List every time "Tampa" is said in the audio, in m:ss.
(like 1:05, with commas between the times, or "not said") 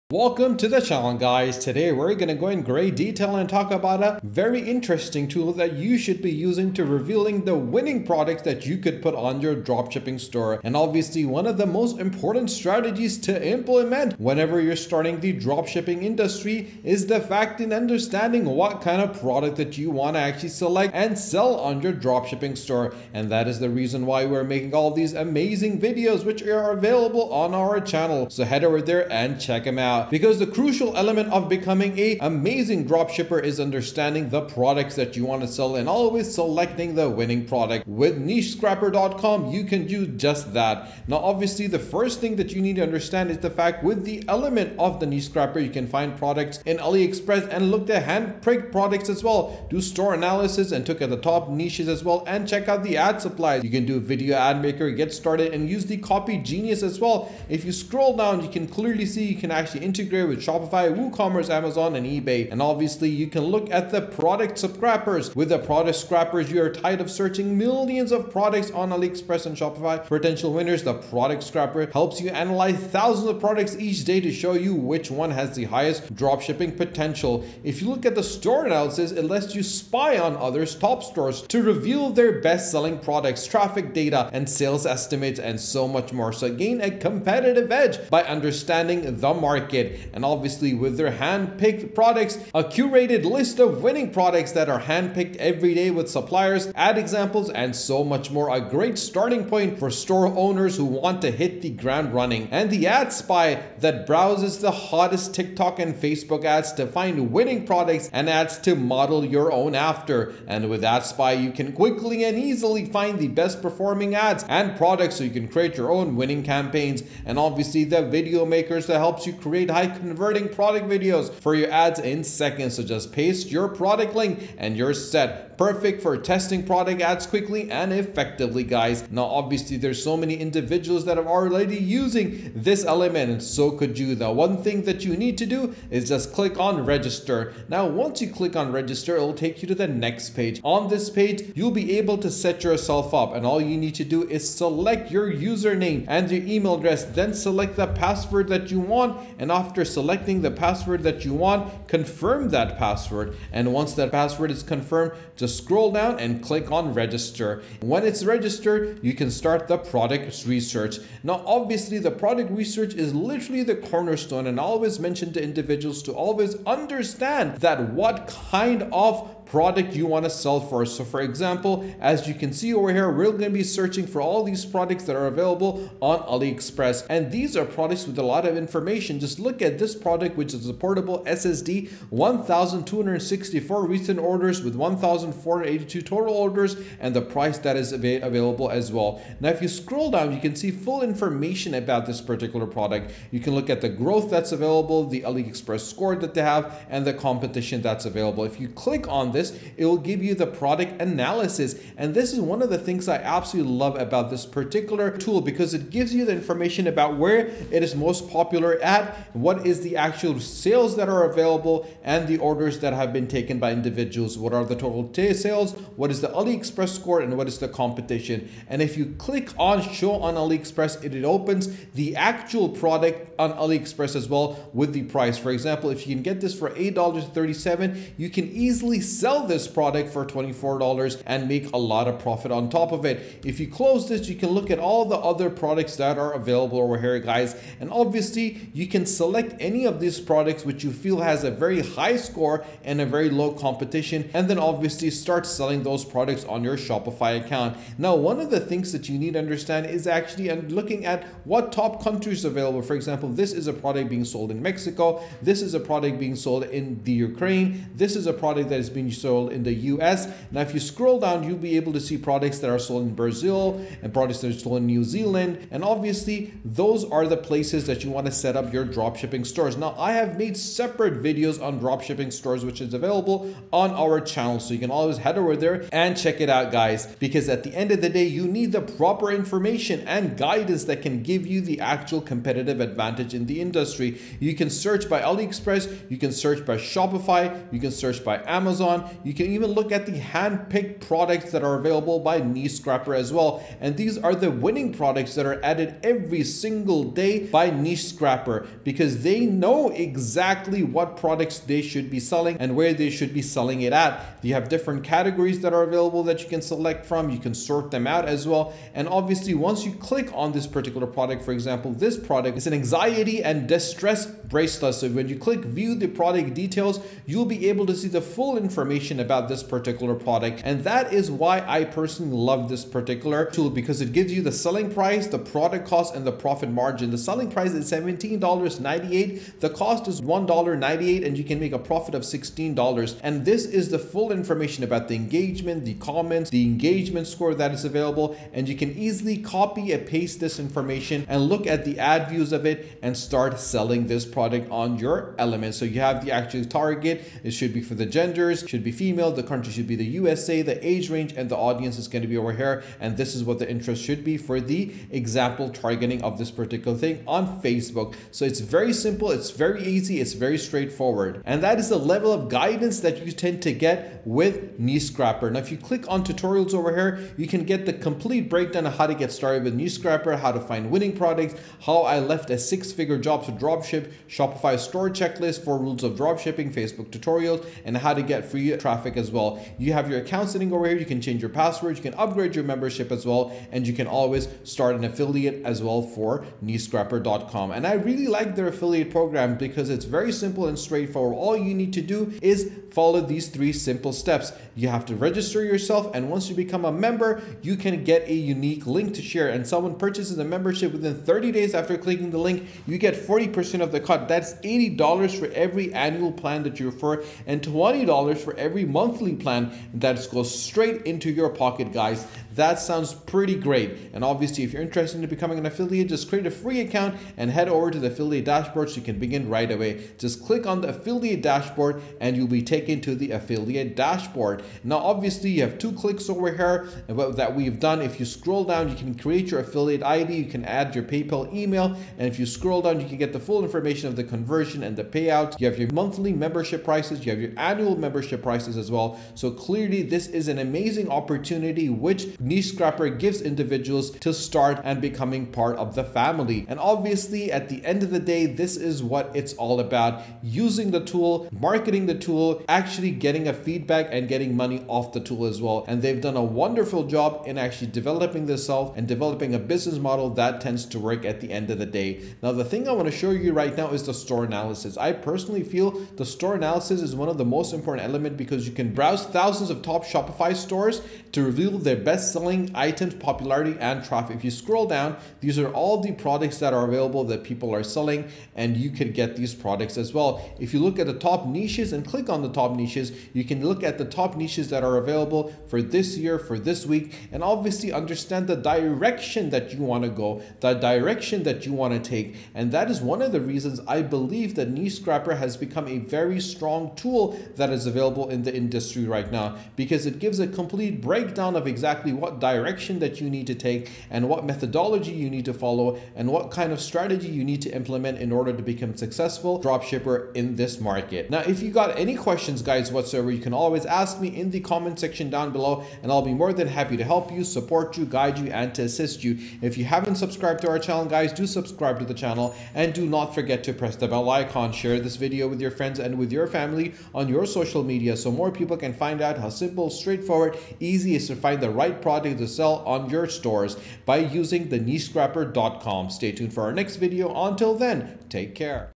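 not said.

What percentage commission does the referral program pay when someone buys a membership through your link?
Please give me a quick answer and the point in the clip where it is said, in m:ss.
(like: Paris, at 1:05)
40%, at 6:43.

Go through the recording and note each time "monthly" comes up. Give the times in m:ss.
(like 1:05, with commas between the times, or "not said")
6:48, 7:15.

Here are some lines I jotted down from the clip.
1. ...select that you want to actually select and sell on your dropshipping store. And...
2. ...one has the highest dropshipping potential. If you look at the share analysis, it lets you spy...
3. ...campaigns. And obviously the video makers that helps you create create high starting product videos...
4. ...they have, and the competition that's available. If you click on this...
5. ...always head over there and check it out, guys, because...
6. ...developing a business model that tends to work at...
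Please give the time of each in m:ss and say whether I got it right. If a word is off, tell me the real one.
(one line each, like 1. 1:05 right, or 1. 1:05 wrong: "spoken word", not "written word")
1. 0:19 wrong: "product", not "select"
2. 1:15 wrong: "store", not "share"
3. 1:56 wrong: "converting", not "starting"
4. 3:16 right
5. 4:34 right
6. 7:39 right.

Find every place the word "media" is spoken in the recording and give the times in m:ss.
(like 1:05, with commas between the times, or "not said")
6:18, 8:47.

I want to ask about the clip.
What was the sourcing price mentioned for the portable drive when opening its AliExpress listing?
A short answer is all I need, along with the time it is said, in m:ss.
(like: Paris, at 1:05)
$8.37, at 3:46.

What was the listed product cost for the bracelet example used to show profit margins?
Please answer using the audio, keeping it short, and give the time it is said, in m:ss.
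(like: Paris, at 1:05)
$1.98, at 5:30.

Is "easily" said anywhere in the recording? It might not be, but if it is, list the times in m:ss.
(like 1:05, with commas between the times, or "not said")
1:52, 3:48, 5:38.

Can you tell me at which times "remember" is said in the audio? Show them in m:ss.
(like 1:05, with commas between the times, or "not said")
not said.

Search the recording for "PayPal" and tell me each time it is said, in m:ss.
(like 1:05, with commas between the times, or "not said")
7:11.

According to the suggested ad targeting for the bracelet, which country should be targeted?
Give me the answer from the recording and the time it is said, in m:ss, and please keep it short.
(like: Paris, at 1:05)
USA, at 5:49.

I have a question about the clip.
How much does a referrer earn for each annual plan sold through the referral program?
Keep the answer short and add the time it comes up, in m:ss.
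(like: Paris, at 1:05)
$80, at 6:44.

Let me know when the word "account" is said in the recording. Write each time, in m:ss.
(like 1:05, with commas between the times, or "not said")
4:07, 6:20, 6:56.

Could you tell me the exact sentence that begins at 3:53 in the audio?
If you close this, you can look at all the other products that are available over here, guys.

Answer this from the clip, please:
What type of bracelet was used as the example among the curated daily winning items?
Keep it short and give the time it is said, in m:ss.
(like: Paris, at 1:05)
anxiety and distress bracelet, at 5:12.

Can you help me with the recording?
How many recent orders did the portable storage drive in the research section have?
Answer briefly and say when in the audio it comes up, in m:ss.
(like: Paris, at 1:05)
1,264, at 3:02.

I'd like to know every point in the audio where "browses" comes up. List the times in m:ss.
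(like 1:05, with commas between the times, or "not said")
1:44, 7:48.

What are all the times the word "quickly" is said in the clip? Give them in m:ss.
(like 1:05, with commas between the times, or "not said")
1:51, 2:07.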